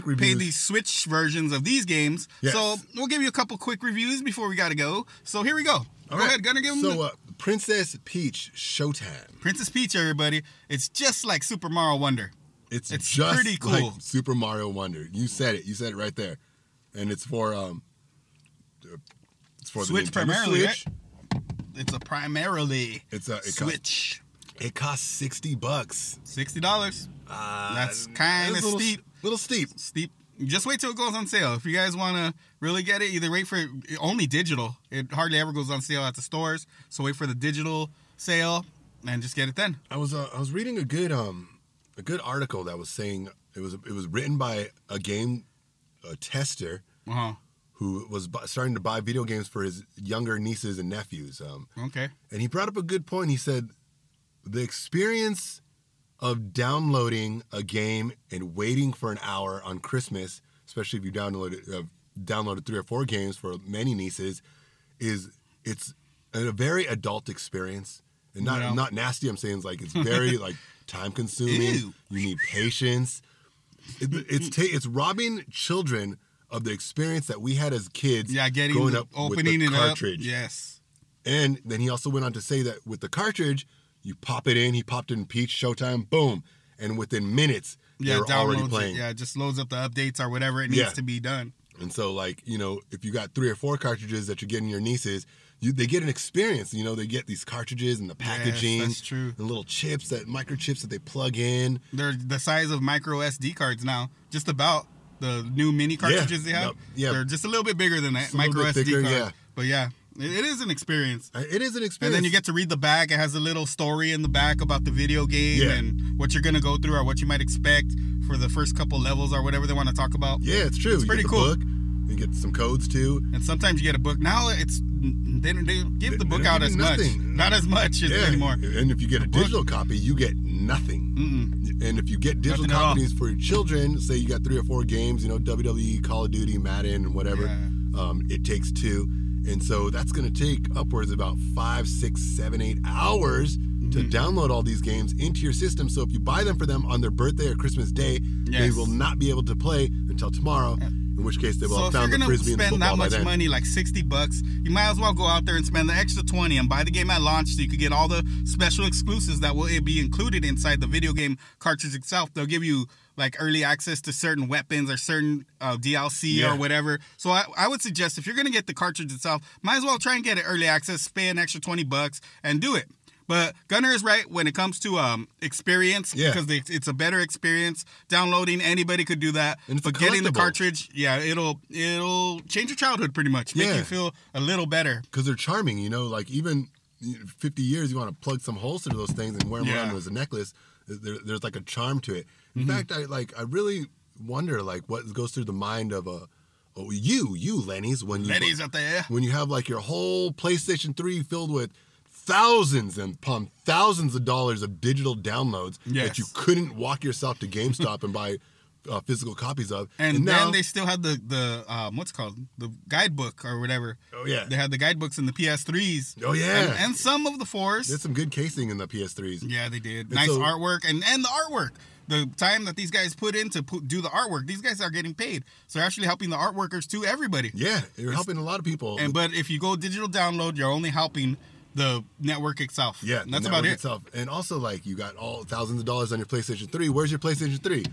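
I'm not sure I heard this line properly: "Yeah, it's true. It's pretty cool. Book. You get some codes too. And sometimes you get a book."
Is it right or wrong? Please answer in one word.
right.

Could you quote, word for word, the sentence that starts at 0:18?
Uh, it's for Switch the primarily, Switch.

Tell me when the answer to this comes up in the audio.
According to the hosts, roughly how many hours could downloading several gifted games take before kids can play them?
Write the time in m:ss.
2:21.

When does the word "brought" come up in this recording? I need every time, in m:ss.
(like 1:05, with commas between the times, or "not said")
0:52.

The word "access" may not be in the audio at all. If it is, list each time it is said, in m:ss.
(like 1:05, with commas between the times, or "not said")
2:43, 2:50.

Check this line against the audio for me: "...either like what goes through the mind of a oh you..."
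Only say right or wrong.
wrong.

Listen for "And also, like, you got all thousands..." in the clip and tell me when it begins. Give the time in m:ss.
3:54.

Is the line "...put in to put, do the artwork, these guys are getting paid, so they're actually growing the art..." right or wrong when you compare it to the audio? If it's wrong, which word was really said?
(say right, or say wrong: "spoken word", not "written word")
wrong: "helping", not "growing".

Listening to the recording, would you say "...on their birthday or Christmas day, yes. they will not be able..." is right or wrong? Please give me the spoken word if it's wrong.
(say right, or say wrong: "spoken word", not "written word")
right.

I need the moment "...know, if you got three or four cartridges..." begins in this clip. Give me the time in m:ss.
1:32.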